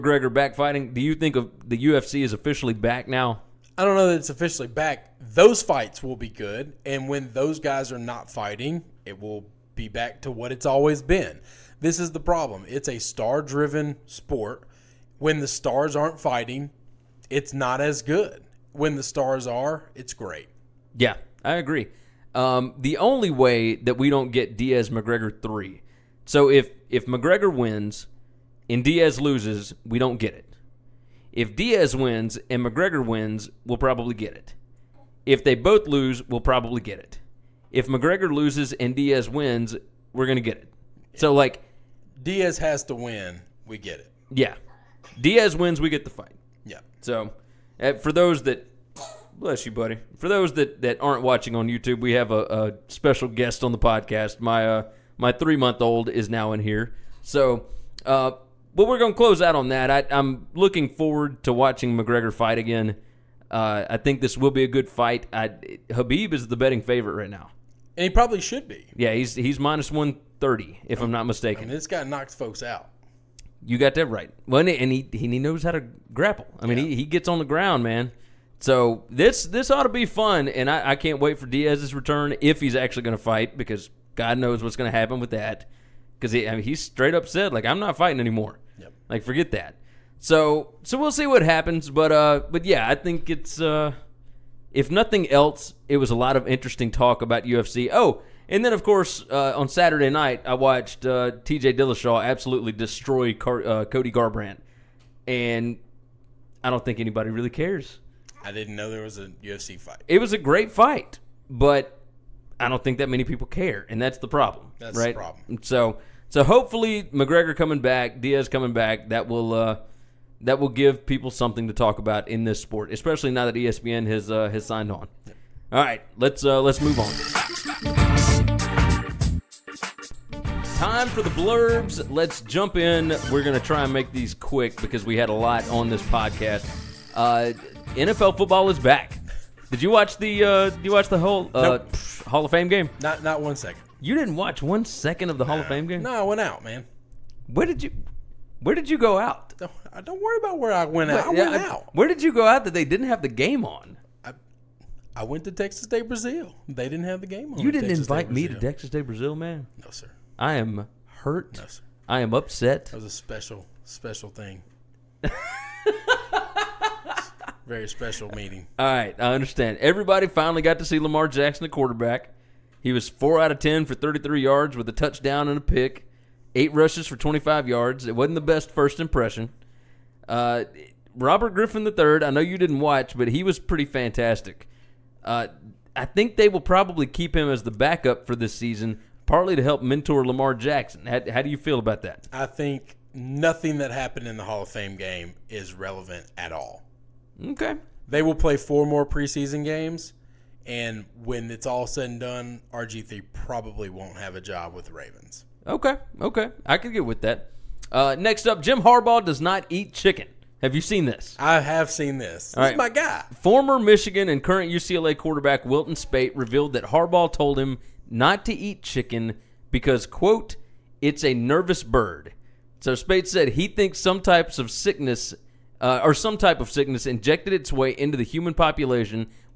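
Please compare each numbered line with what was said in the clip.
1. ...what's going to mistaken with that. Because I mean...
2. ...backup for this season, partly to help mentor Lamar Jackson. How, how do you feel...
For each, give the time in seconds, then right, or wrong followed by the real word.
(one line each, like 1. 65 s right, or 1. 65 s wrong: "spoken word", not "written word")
1. 84 s wrong: "happen", not "mistaken"
2. 187 s right.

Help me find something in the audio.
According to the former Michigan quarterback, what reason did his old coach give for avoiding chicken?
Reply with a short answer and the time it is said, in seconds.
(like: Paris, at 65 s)
it's a nervous bird, at 221 s.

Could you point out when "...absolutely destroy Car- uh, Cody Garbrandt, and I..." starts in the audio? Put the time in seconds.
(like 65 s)
102 s.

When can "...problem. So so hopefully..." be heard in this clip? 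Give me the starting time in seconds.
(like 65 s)
115 s.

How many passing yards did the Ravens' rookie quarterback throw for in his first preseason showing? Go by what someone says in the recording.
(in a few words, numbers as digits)
33.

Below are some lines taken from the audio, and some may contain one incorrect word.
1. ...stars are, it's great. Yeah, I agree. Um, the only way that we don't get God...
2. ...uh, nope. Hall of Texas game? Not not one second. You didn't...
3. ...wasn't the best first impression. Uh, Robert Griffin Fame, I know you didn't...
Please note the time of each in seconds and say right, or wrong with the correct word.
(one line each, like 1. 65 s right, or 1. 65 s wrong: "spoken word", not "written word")
1. 19 s wrong: "Diaz", not "God"
2. 141 s wrong: "Fame", not "Texas"
3. 178 s wrong: "III", not "Fame".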